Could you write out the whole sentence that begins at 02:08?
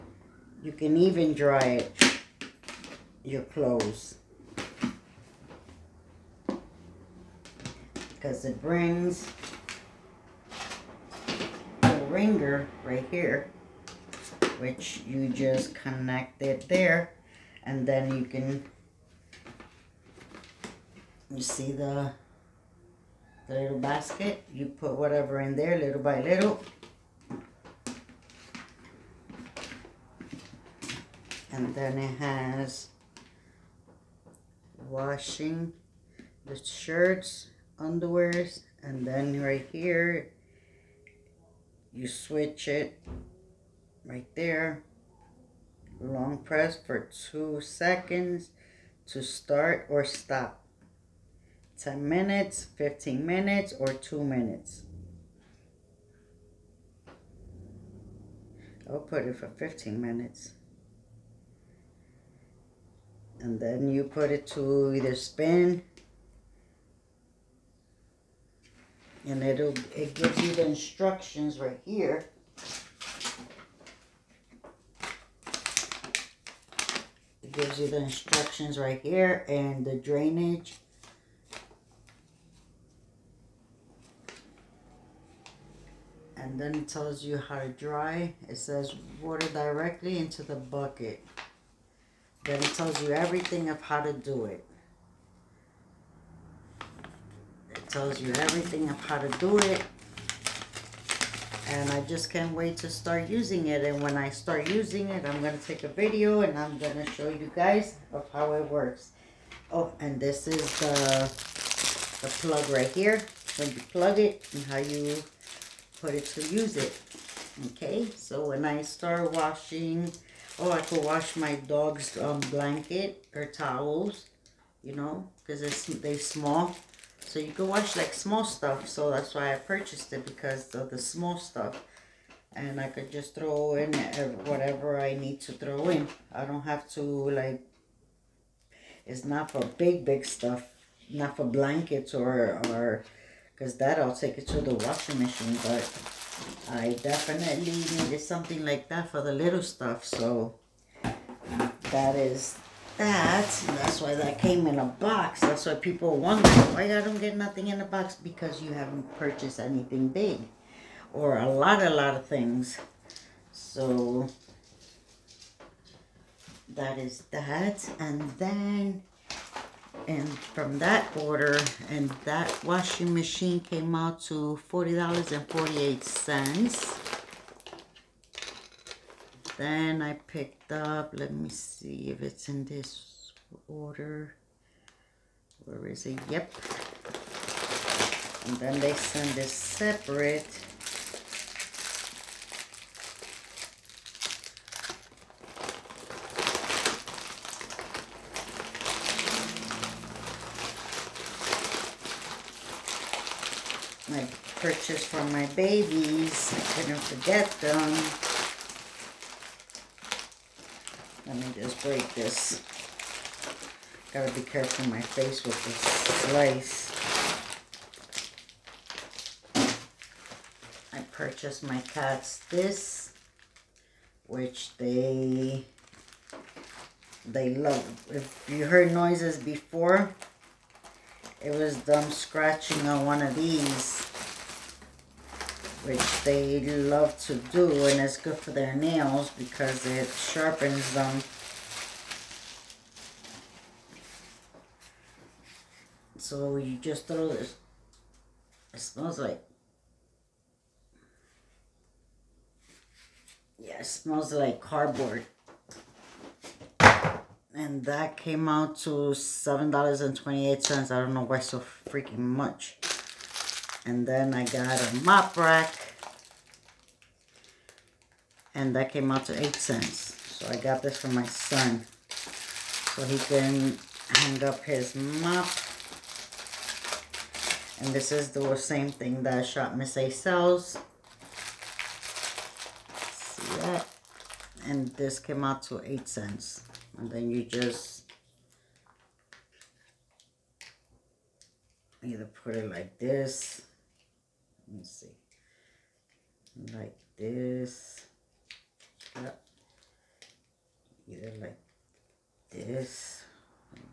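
So that's why I purchased it because of the small stuff.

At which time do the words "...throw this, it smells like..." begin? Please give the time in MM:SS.
04:07.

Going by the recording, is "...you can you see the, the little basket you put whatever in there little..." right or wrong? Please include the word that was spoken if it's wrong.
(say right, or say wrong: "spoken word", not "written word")
right.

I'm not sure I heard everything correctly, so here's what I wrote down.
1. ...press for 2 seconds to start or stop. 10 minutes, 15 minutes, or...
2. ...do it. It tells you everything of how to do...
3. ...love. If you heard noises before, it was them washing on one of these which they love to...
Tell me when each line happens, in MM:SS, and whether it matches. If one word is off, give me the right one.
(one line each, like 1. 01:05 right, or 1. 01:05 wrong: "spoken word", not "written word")
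1. 00:46 right
2. 01:34 right
3. 03:47 wrong: "scratching", not "washing".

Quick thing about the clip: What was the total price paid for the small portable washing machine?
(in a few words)
$40.48.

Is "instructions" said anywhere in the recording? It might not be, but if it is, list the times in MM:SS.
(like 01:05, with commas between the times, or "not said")
01:10, 01:17.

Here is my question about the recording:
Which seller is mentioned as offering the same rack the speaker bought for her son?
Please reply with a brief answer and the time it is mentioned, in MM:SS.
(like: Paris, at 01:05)
Shop Miss A, at 04:39.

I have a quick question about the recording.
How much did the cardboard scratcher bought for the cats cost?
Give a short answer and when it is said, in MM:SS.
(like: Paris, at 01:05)
$7.28, at 04:18.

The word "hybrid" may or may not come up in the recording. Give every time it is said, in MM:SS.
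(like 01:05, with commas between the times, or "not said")
not said.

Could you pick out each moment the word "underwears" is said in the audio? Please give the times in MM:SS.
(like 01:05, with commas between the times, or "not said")
00:37.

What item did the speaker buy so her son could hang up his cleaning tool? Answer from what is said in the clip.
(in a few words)
mop rack.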